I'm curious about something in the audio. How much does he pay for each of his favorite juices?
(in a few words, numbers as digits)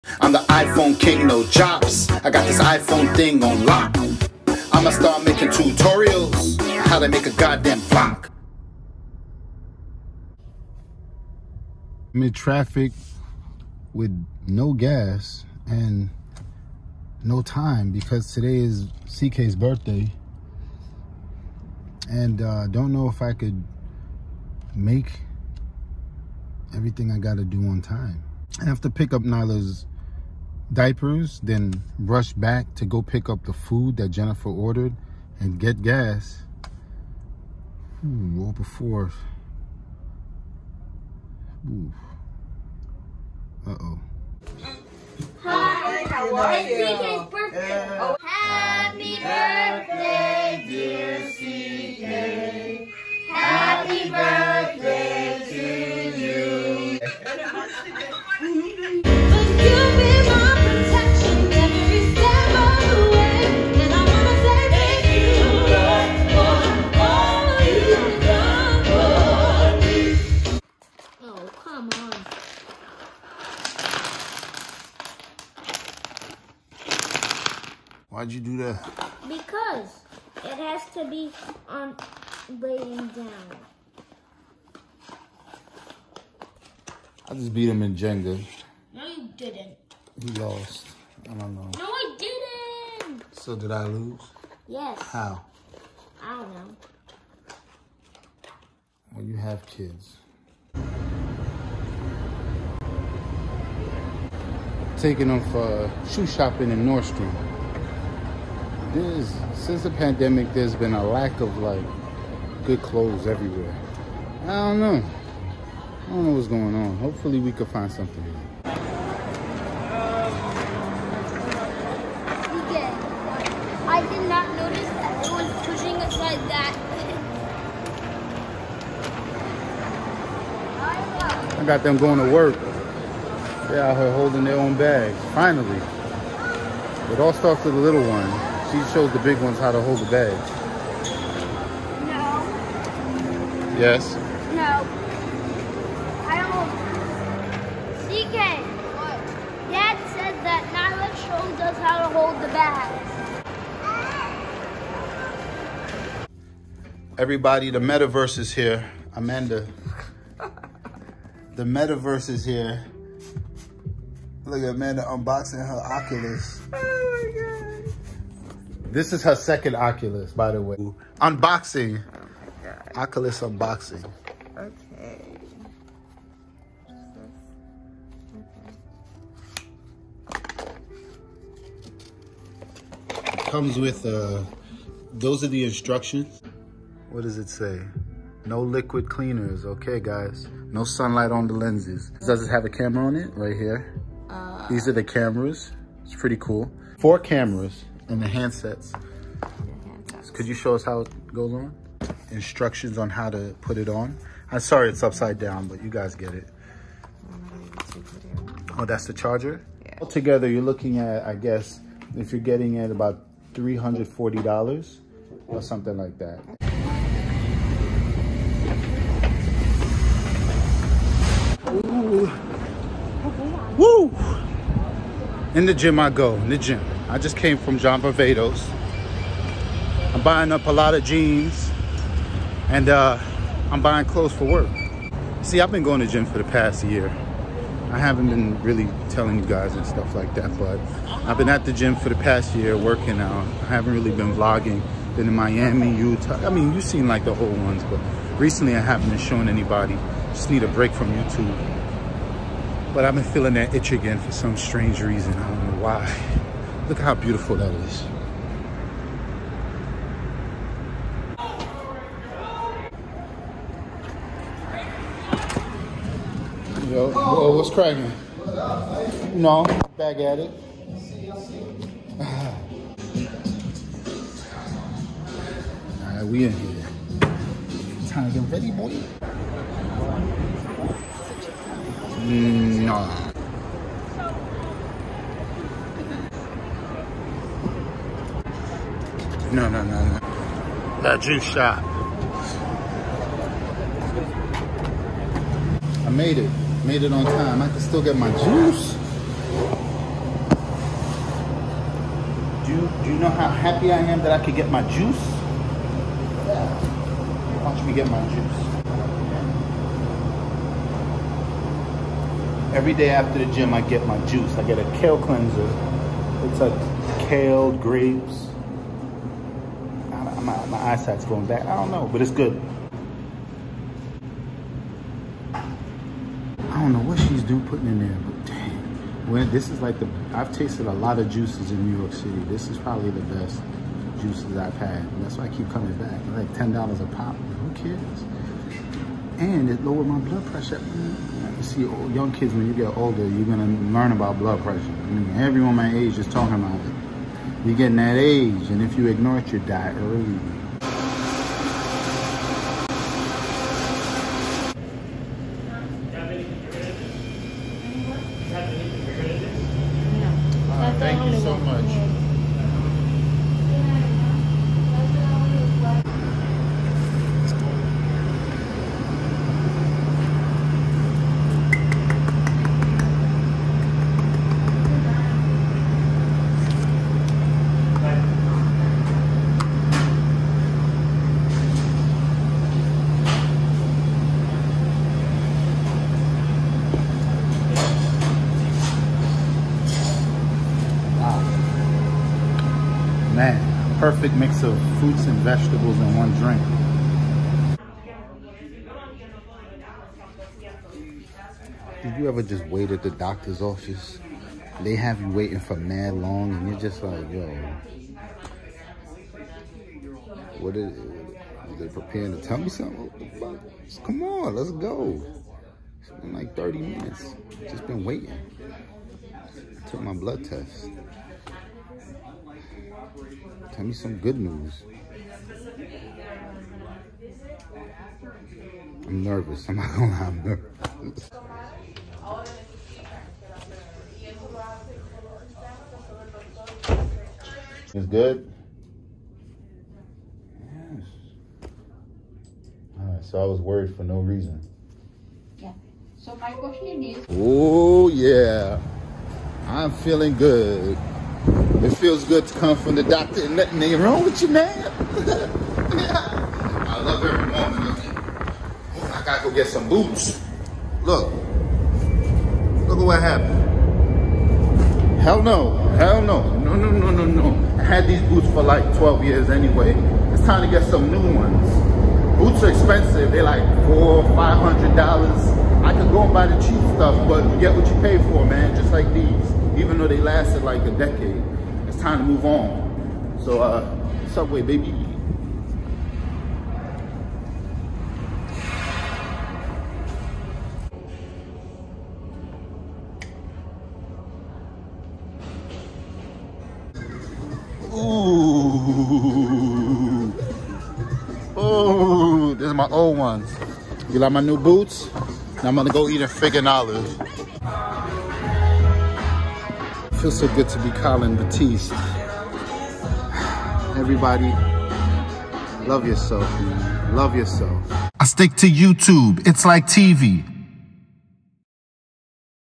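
$10.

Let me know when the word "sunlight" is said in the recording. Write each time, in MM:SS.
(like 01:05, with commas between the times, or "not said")
03:10.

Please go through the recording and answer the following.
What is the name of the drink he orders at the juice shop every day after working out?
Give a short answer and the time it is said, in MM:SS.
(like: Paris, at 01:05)
kale cleanser, at 05:15.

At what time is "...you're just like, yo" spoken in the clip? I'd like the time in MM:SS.
06:46.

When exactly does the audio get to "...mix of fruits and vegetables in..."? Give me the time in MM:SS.
06:34.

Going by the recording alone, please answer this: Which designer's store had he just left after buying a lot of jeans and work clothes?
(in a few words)
John Varvatos.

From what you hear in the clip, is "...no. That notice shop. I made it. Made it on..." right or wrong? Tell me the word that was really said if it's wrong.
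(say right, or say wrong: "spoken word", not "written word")
wrong: "juice", not "notice".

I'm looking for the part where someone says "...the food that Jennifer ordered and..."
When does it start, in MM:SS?
00:33.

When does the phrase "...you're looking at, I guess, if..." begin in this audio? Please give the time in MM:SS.
03:30.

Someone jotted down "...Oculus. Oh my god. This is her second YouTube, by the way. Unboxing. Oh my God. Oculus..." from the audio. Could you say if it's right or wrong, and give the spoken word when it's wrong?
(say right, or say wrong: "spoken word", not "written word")
wrong: "Oculus", not "YouTube".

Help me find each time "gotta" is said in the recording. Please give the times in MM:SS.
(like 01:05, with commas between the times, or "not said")
00:27, 07:39.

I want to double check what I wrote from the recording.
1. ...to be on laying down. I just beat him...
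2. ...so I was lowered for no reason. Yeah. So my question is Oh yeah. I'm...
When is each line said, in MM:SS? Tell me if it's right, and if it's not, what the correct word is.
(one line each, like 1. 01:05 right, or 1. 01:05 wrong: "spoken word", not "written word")
1. 01:20 right
2. 07:23 wrong: "worried", not "lowered".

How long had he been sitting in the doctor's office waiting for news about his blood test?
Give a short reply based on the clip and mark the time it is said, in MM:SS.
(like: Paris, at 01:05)
30 minutes, at 06:56.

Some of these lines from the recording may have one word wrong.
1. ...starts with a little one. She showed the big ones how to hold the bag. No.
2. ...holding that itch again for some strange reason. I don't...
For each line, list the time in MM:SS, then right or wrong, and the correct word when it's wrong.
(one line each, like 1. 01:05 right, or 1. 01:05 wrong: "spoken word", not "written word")
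1. 02:17 right
2. 04:13 wrong: "feeling", not "holding".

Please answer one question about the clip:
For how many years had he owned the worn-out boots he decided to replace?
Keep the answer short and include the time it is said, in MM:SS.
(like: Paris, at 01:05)
12 years, at 07:48.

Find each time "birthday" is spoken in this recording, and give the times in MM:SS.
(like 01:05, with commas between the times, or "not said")
00:19, 00:47.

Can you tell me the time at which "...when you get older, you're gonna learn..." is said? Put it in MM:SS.
05:42.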